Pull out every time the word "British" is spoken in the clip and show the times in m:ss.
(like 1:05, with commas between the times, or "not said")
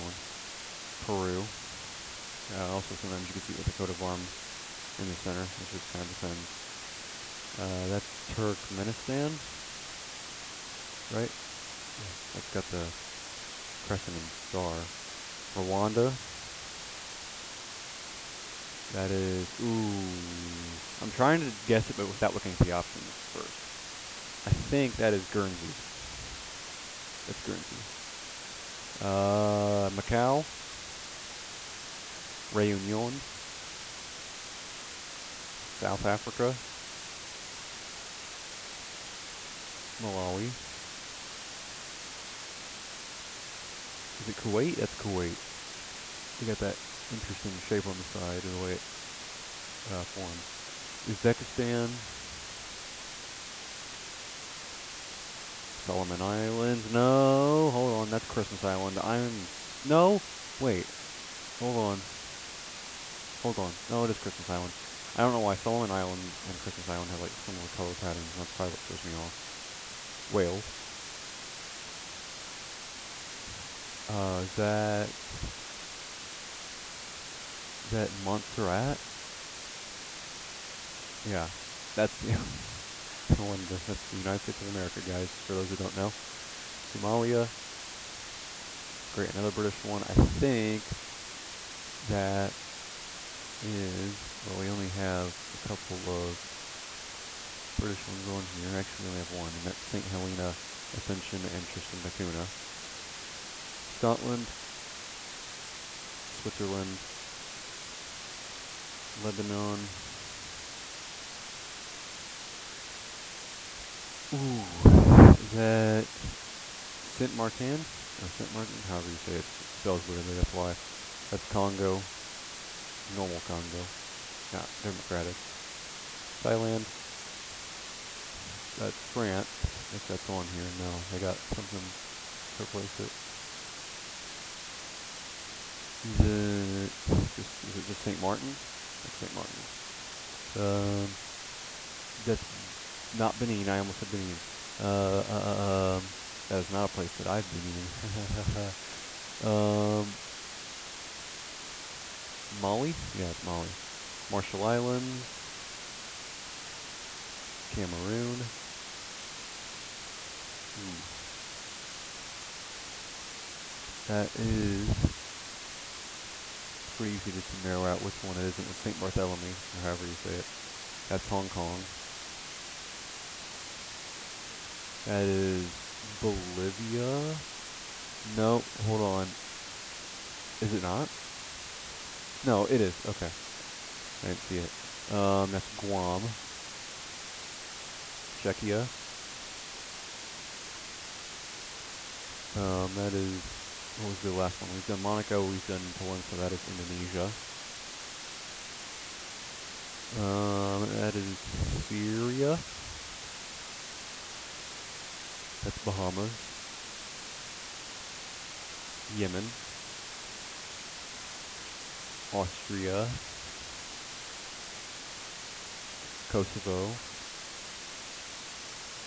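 1:29, 1:37.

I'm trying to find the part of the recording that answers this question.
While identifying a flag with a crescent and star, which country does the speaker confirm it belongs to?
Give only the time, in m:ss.
0:08.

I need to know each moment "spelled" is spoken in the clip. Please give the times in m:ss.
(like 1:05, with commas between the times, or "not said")
1:59.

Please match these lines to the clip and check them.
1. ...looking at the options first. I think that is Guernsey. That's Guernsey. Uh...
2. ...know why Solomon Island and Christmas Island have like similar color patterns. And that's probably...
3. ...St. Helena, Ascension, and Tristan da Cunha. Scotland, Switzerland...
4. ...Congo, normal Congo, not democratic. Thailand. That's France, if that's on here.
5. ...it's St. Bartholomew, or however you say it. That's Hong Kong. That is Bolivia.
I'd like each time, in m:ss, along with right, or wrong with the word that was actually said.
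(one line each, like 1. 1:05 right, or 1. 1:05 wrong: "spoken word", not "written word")
1. 0:22 right
2. 1:05 right
3. 1:39 right
4. 2:01 right
5. 2:48 right.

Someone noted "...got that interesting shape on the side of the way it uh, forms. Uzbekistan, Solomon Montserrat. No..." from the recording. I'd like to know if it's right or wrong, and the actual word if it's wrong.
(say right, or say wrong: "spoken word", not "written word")
wrong: "Islands", not "Montserrat".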